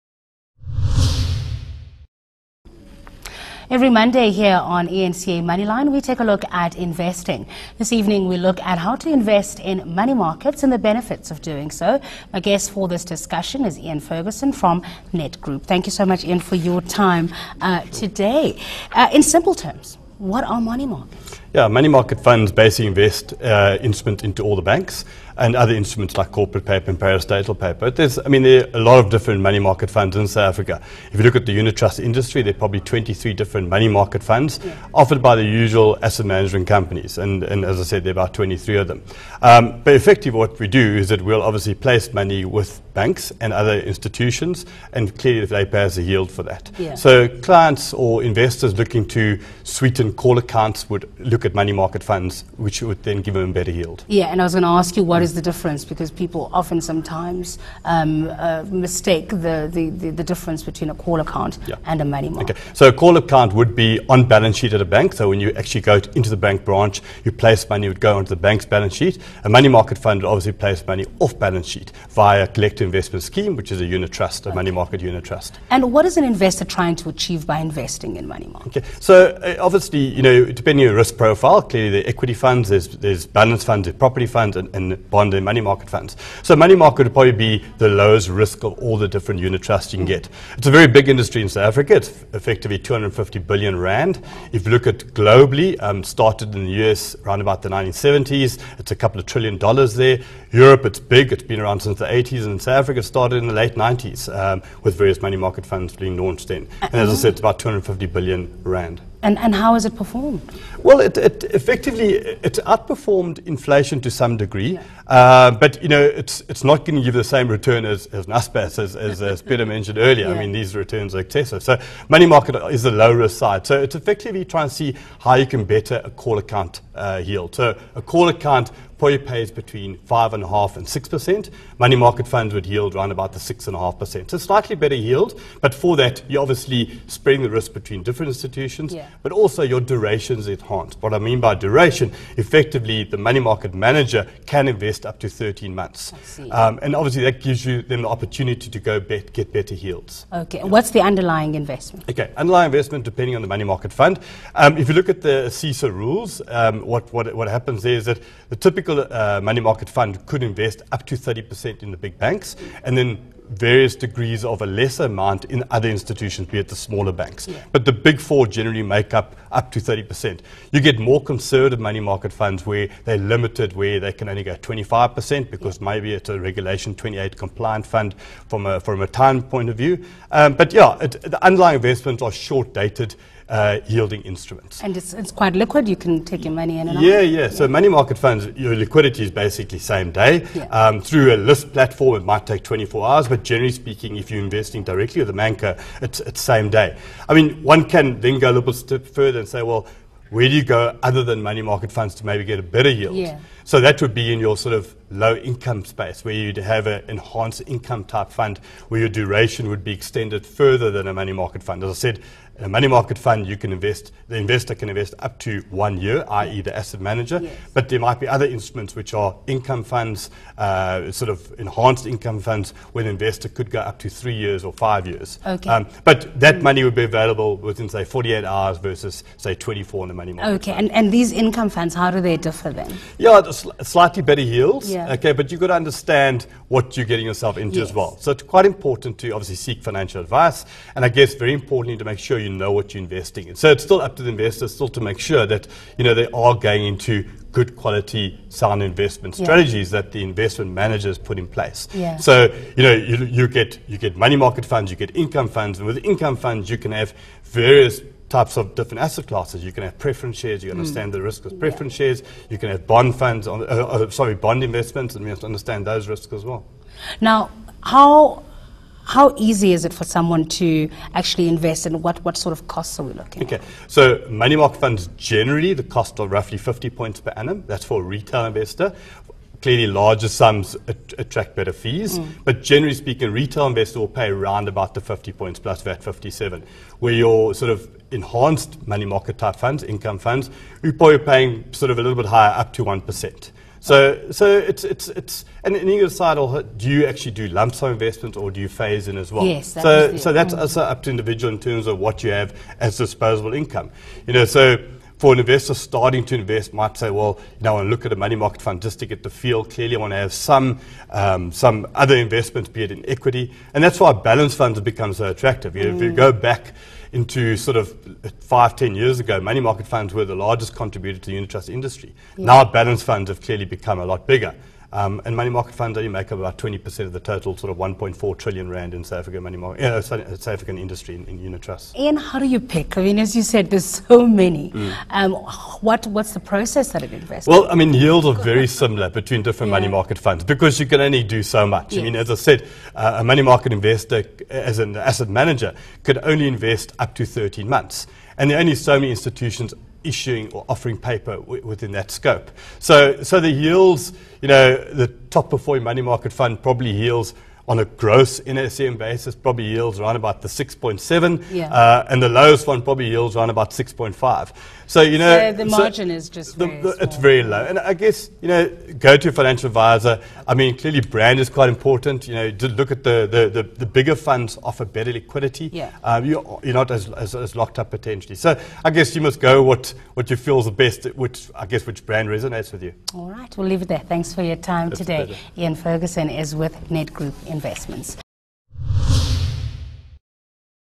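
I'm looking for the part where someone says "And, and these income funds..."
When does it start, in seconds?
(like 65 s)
230 s.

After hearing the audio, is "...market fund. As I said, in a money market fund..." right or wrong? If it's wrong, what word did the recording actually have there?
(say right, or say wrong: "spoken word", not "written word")
right.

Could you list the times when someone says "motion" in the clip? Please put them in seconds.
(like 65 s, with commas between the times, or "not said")
not said.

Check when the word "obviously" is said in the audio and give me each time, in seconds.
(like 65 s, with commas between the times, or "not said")
41 s, 70 s, 79 s, 136 s, 146 s, 239 s.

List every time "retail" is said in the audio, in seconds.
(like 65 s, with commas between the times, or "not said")
278 s, 283 s.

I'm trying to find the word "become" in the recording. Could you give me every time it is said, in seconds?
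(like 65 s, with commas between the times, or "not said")
314 s, 323 s.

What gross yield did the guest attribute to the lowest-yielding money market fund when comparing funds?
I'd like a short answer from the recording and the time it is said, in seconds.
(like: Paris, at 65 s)
6.5, at 363 s.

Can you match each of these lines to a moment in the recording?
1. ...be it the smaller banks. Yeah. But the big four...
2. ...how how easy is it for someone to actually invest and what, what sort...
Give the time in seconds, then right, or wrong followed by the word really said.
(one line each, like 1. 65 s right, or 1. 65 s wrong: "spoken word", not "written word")
1. 166 s right
2. 267 s right.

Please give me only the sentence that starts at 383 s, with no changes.
All right, we'll leave it there.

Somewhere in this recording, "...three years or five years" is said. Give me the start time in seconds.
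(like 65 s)
224 s.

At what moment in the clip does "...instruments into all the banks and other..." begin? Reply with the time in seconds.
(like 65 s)
23 s.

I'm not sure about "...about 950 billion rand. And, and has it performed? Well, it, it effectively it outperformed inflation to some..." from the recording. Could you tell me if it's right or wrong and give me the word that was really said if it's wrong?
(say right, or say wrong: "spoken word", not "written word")
wrong: "250", not "950".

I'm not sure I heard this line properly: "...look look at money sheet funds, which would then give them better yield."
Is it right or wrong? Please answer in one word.
wrong.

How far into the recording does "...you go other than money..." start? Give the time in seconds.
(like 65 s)
200 s.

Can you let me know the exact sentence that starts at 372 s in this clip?
You know, look at the, the, the, the, bigger funds offer better liquidity.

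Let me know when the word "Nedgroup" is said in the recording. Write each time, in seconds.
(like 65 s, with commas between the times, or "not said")
15 s, 386 s.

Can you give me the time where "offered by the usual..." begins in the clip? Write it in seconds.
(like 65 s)
34 s.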